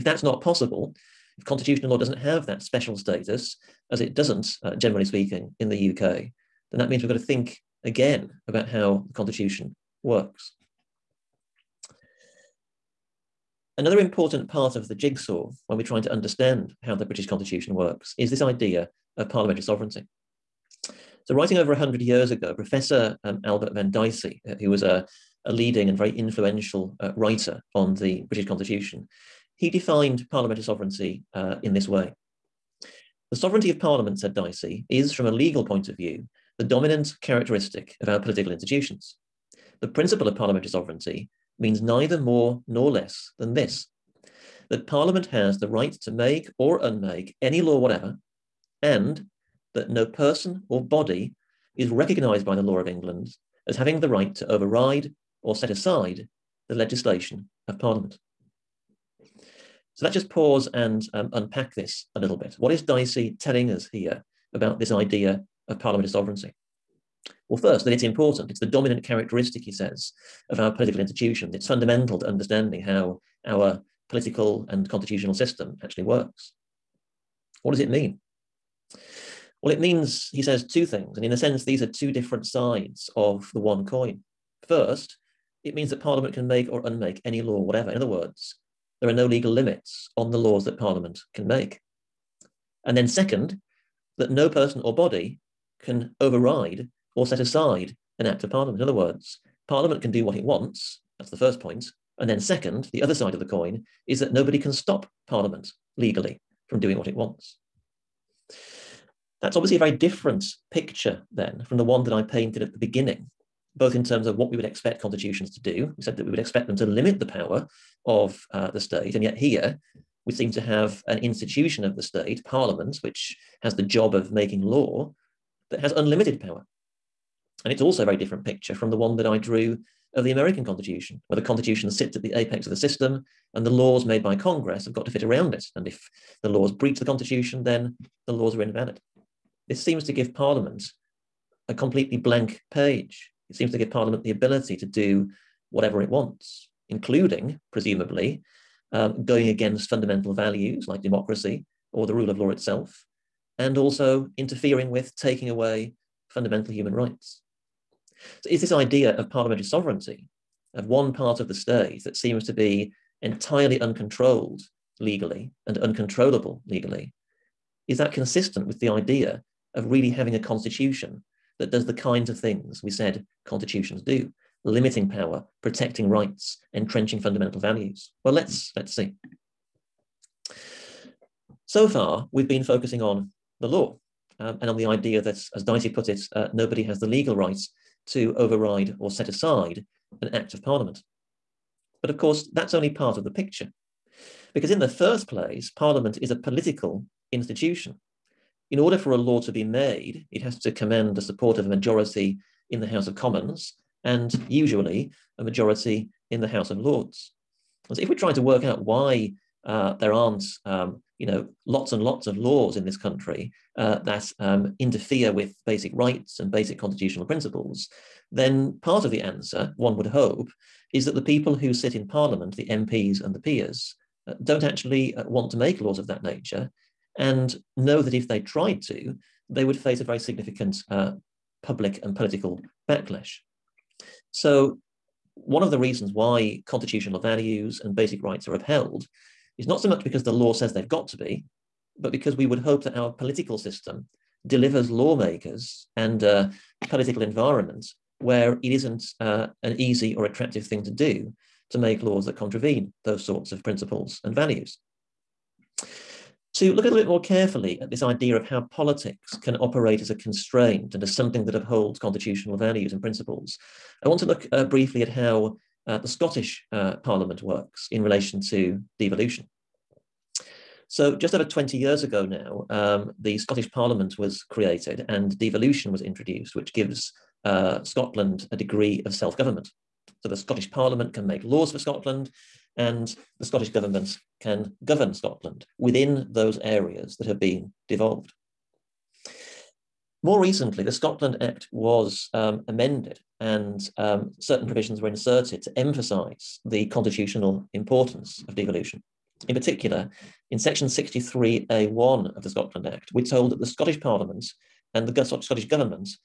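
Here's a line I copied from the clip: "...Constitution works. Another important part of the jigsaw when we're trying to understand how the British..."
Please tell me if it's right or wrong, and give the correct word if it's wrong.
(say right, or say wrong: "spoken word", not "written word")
right.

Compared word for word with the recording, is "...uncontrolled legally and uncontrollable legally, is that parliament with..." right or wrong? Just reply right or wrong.
wrong.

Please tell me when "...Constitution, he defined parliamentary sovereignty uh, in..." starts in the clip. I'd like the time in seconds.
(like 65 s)
28 s.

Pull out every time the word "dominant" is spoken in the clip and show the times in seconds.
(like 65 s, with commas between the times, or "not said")
36 s, 68 s.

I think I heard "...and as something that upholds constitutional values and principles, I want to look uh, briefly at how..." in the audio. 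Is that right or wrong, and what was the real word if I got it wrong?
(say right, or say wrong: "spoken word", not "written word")
right.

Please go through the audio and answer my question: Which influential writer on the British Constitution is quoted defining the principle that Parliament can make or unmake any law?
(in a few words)
Albert Venn Dicey.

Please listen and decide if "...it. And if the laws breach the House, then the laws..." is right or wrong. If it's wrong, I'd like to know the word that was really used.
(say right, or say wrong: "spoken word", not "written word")
wrong: "Constitution", not "House".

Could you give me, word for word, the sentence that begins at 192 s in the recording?
But of course, that's only part of the picture.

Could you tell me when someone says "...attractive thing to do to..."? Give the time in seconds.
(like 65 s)
250 s.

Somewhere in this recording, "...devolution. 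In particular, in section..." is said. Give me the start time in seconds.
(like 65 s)
298 s.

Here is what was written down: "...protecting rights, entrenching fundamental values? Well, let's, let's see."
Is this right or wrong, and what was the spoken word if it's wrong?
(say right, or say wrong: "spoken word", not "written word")
right.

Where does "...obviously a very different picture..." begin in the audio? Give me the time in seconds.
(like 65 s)
109 s.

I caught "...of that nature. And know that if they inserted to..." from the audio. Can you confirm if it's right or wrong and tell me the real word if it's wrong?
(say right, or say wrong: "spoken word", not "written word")
wrong: "tried", not "inserted".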